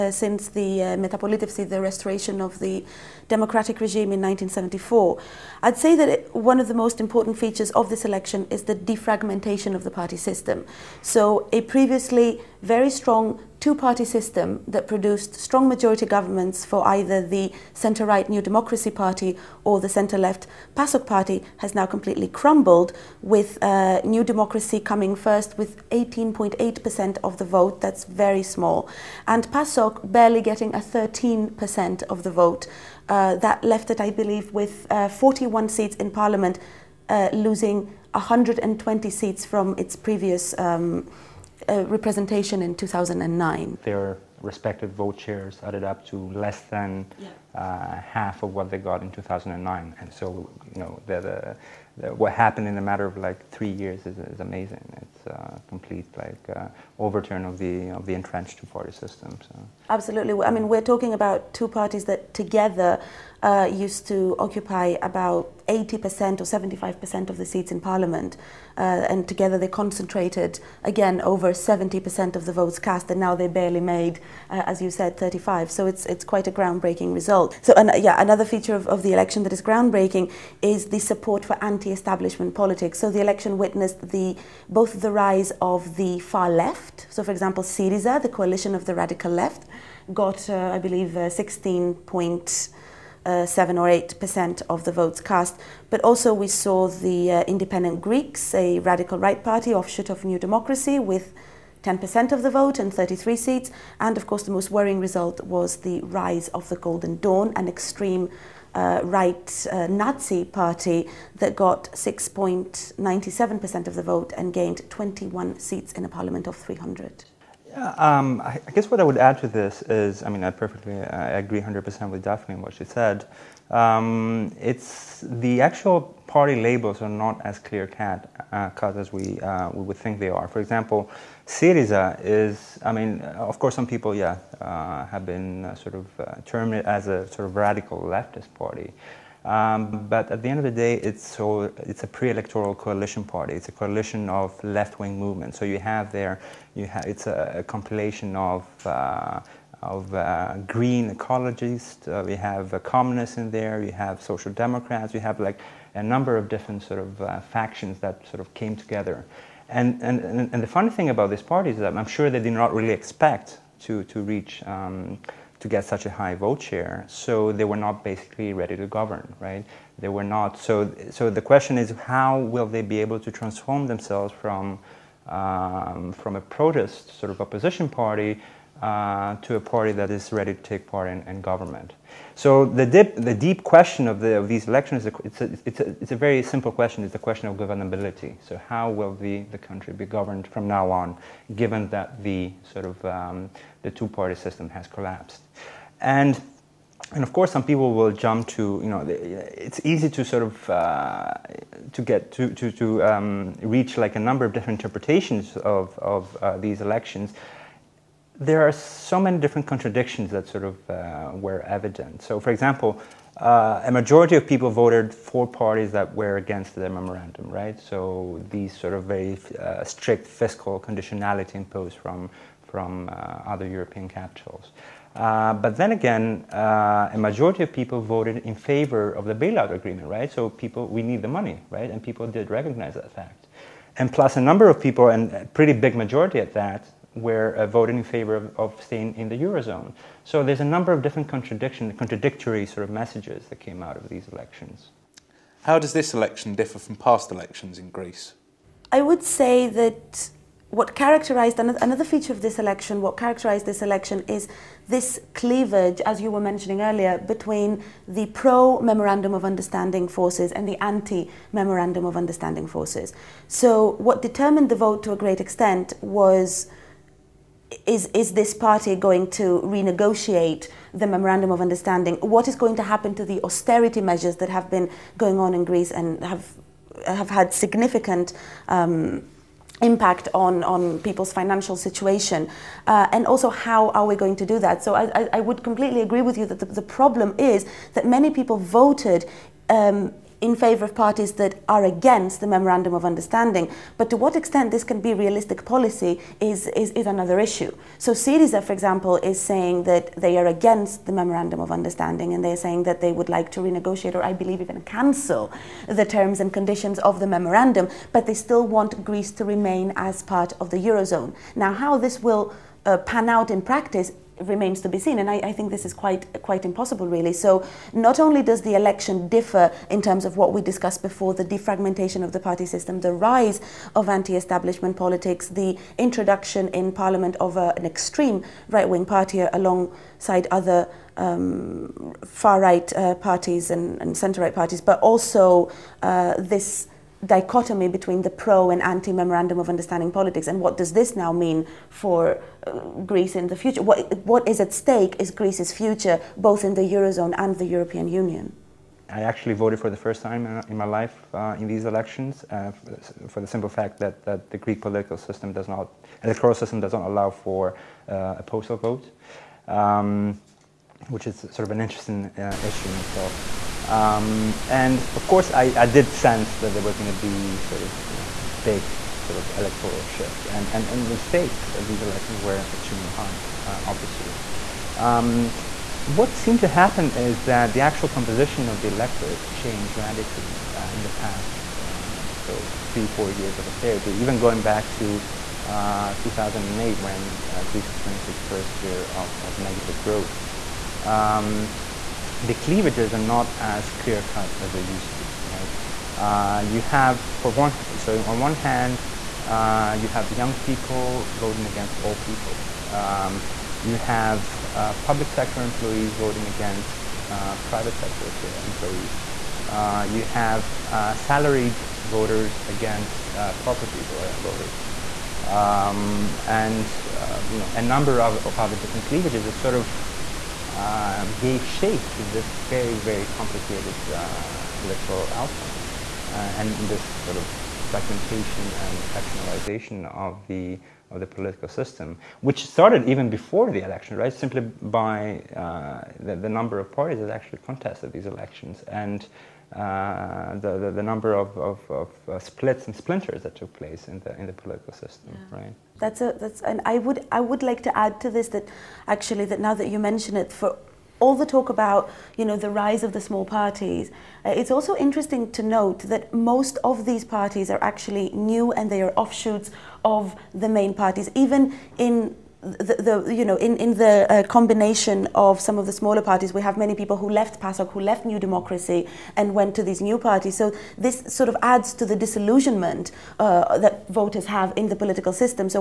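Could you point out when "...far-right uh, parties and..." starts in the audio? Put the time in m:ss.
5:32.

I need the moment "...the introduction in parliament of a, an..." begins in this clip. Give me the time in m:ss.
5:25.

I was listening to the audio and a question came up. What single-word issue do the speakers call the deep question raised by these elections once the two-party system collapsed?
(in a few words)
Governability.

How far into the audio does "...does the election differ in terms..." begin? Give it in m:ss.
5:18.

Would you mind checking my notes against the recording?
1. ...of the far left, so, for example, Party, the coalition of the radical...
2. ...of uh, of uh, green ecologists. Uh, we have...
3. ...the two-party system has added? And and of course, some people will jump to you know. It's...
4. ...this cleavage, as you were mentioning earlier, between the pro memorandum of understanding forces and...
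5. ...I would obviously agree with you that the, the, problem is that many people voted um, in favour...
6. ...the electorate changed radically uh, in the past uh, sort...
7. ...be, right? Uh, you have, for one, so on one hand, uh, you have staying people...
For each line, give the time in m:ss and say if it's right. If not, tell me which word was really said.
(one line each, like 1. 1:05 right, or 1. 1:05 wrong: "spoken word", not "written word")
1. 1:25 wrong: "Syriza", not "Party"
2. 2:28 right
3. 3:13 wrong: "collapsed", not "added"
4. 4:14 right
5. 4:45 wrong: "completely", not "obviously"
6. 6:18 right
7. 6:35 wrong: "young", not "staying".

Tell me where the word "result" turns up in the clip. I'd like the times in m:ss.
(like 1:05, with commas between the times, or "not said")
1:17, 1:44.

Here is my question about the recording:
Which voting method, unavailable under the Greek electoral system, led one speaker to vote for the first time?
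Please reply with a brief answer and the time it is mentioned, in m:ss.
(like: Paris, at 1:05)
Postal vote, at 5:58.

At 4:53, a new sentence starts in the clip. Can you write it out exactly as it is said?
But to what extent this can be realistic policy is, is, is another issue.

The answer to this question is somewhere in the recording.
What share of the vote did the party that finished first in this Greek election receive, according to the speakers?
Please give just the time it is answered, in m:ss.
0:25.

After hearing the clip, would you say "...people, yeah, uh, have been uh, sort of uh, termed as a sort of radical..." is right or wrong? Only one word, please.
right.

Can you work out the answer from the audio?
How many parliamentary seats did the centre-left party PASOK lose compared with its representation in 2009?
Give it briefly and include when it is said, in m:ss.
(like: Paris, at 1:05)
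120, at 0:38.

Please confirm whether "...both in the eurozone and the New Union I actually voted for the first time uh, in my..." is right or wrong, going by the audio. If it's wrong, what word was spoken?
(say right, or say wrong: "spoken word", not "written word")
wrong: "European", not "New".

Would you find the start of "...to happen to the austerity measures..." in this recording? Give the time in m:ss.
4:32.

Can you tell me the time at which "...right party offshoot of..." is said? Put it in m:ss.
1:39.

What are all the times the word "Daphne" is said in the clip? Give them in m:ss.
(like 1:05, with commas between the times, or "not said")
2:02.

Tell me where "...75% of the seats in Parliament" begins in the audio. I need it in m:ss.
1:06.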